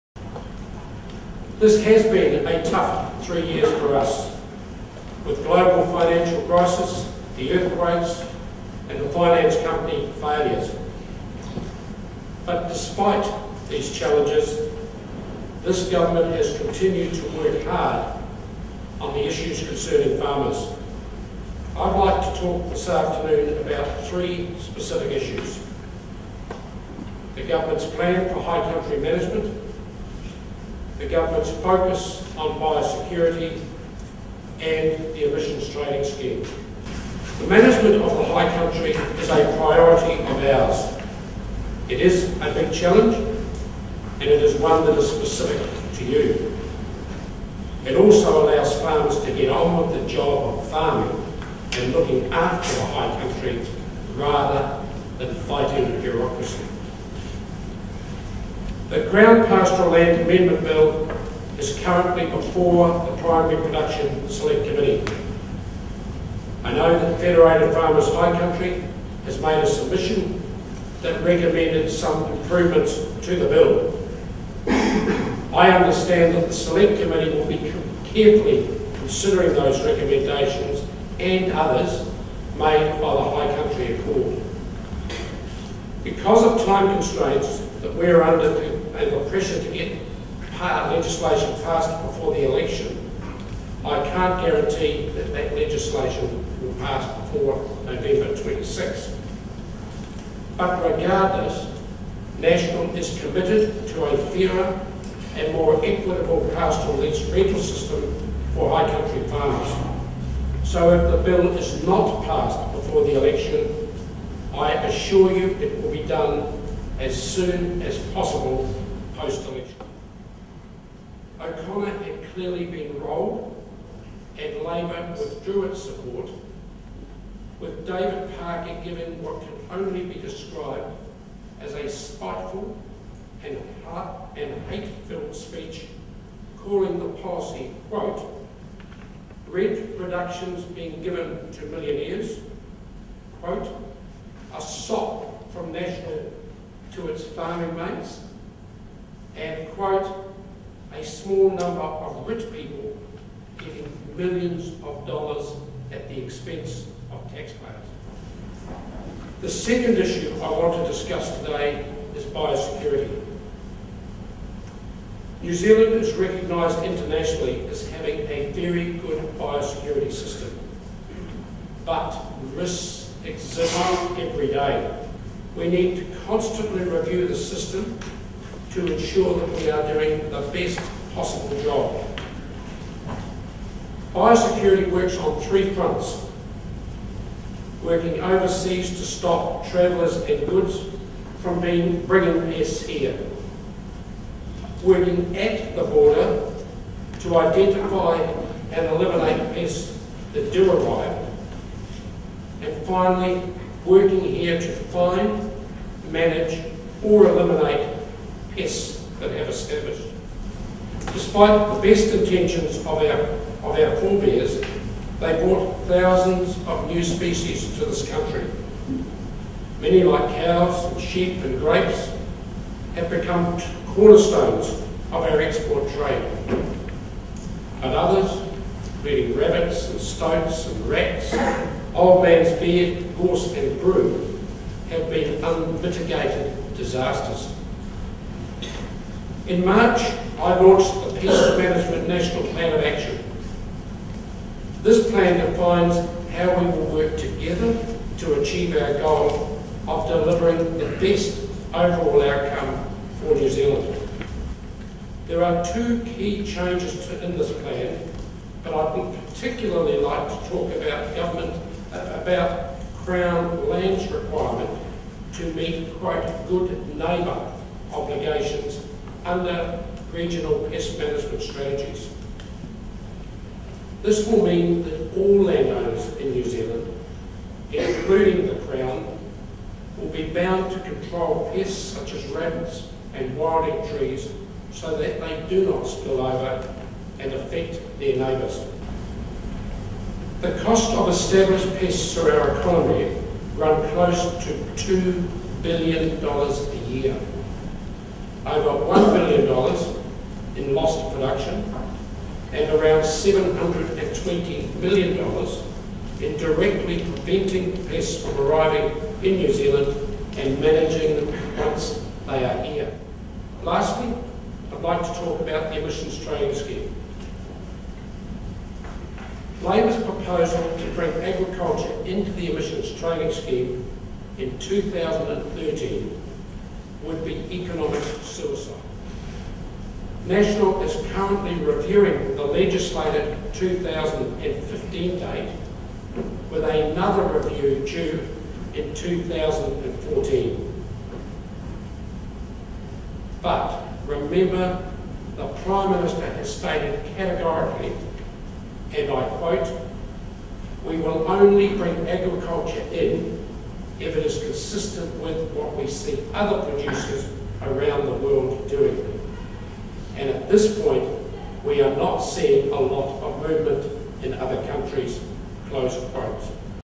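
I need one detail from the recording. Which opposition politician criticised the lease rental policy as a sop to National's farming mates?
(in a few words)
David Parker.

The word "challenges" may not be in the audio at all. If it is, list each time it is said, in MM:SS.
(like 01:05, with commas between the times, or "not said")
00:13, 00:42.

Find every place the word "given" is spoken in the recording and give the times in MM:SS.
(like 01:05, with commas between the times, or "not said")
02:08, 02:21.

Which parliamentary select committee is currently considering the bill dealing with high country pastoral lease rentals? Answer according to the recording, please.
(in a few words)
Primary Production Select Committee.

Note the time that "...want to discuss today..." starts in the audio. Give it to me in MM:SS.
02:40.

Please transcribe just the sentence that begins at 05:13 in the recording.
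Lastly, I'd like to talk about the emissions trading scheme.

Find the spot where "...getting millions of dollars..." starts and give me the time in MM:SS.
02:33.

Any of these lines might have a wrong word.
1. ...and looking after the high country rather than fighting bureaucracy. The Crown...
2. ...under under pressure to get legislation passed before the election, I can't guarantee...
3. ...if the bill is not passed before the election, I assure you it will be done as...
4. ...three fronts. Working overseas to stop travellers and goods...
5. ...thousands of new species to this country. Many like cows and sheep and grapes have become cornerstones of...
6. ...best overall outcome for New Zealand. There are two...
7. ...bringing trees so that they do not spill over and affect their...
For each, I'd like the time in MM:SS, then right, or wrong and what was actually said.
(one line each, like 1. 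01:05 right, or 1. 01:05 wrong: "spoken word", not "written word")
1. 00:51 right
2. 01:28 right
3. 01:50 right
4. 03:05 right
5. 03:35 right
6. 04:11 right
7. 04:43 wrong: "wilding", not "bringing".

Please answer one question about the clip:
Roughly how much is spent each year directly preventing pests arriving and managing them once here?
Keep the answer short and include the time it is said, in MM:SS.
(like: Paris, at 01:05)
$720 million, at 05:03.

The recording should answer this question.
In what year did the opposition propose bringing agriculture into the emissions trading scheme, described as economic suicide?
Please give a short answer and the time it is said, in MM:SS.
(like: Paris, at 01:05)
2013, at 05:24.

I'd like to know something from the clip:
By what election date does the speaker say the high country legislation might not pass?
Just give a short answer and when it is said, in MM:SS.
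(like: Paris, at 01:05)
November 26, at 01:37.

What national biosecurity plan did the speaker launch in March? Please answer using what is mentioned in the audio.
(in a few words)
Pest Management National Plan of Action.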